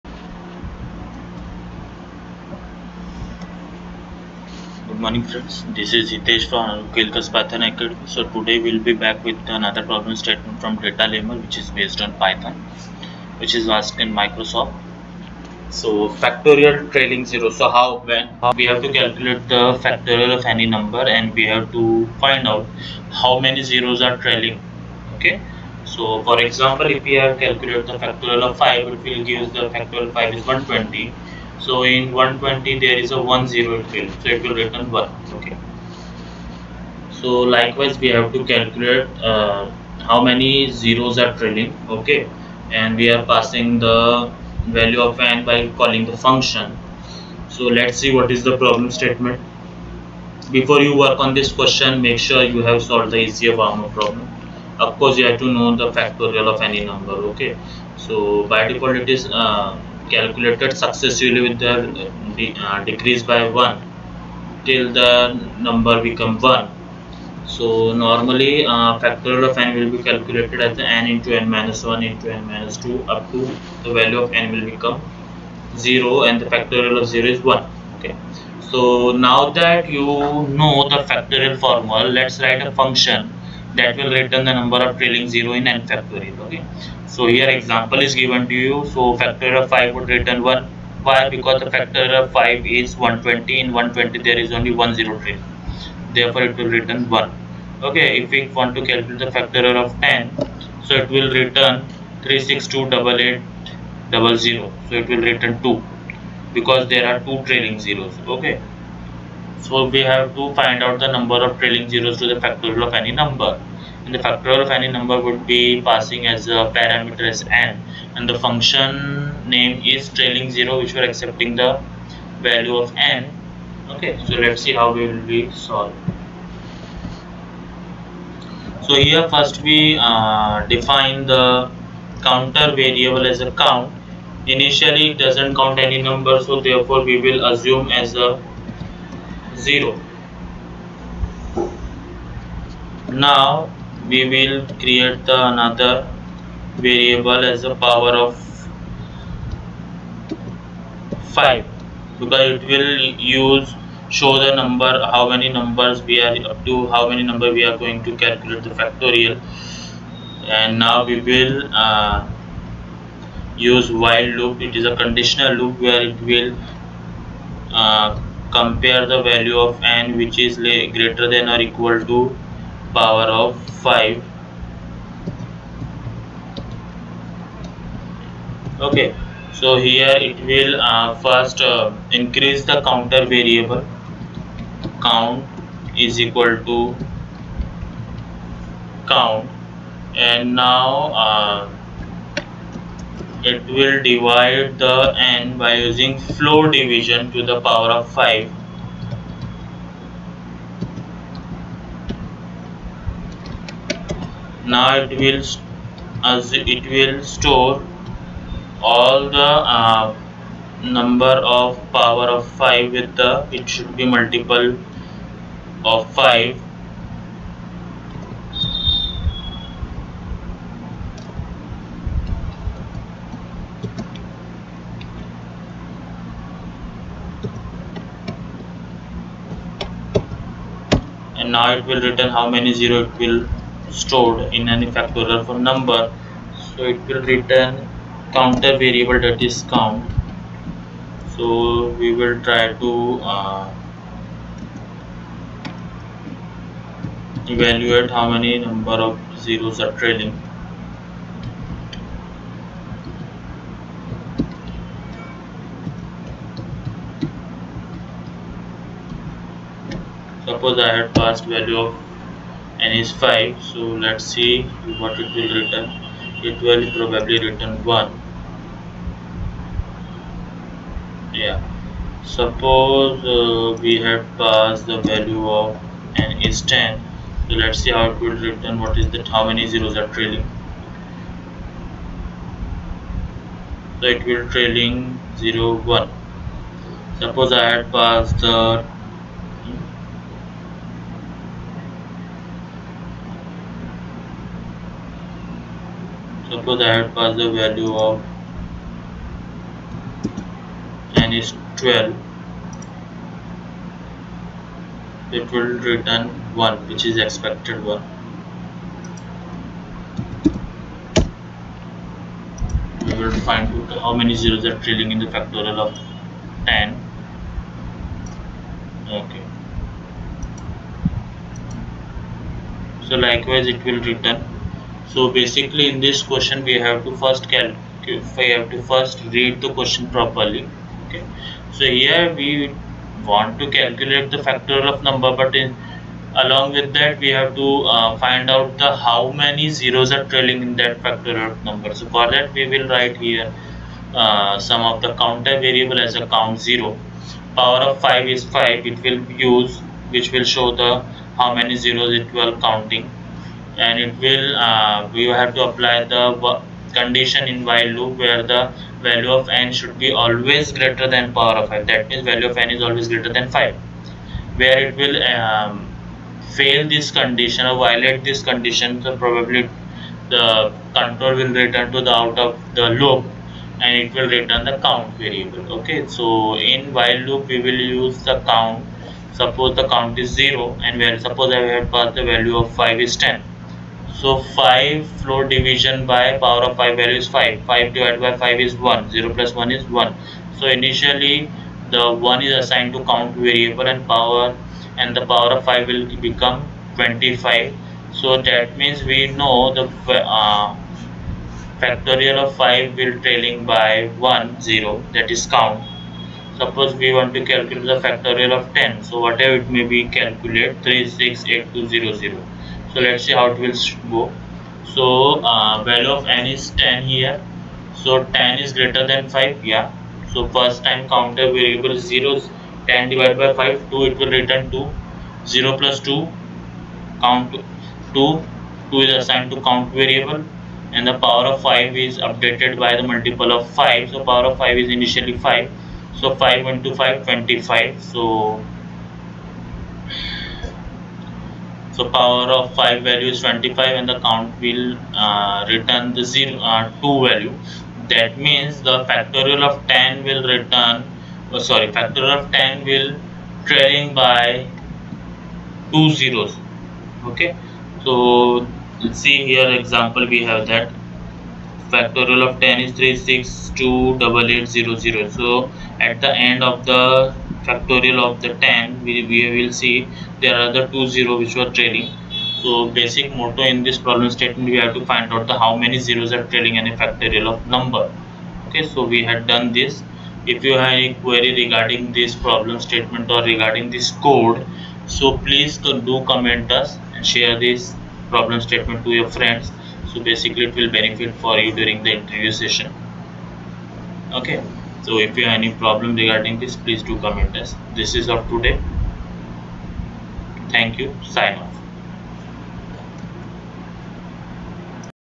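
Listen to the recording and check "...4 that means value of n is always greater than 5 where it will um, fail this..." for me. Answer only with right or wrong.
wrong.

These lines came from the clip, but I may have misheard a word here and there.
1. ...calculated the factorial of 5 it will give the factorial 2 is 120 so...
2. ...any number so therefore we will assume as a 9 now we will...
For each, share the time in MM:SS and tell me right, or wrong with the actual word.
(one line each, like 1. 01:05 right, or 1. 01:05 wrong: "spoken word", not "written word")
1. 00:27 wrong: "5", not "2"
2. 02:15 wrong: "0", not "9".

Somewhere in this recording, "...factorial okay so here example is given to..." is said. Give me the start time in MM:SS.
01:25.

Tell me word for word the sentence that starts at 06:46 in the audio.
Suppose we want to calculate the factorial of 10.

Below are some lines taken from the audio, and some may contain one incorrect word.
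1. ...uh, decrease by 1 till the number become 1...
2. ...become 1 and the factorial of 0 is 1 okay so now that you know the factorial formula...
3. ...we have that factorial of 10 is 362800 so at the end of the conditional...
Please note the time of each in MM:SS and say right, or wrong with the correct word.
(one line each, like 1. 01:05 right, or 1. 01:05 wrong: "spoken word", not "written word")
1. 01:02 right
2. 01:14 wrong: "0", not "1"
3. 07:40 wrong: "factorial", not "conditional".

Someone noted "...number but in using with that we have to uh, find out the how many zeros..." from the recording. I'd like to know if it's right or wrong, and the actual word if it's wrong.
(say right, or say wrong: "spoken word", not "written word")
wrong: "along", not "using".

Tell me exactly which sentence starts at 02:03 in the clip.
Okay, so let's see how we will be solved.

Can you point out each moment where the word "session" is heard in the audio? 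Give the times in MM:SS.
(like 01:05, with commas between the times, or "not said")
08:12.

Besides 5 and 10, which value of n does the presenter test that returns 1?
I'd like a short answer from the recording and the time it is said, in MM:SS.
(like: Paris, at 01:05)
12, at 05:01.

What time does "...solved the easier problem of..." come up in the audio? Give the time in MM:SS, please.
00:52.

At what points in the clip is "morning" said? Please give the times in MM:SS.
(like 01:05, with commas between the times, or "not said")
00:05.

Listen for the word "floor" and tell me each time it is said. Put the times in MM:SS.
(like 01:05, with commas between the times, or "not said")
03:16, 06:25.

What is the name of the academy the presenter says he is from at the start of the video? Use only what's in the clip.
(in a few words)
Kelkars Python Academy.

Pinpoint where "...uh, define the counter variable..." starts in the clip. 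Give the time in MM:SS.
02:10.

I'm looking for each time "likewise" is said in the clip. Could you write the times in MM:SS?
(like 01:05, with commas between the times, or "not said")
00:37, 05:23.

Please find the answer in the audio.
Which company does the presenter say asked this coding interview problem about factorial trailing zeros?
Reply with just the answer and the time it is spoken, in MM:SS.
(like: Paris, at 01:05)
Microsoft, at 00:14.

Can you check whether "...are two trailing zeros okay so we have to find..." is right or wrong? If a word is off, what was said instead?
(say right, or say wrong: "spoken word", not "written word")
right.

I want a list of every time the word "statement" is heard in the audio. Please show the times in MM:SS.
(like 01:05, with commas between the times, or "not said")
00:10, 00:48, 07:54, 08:02, 08:08.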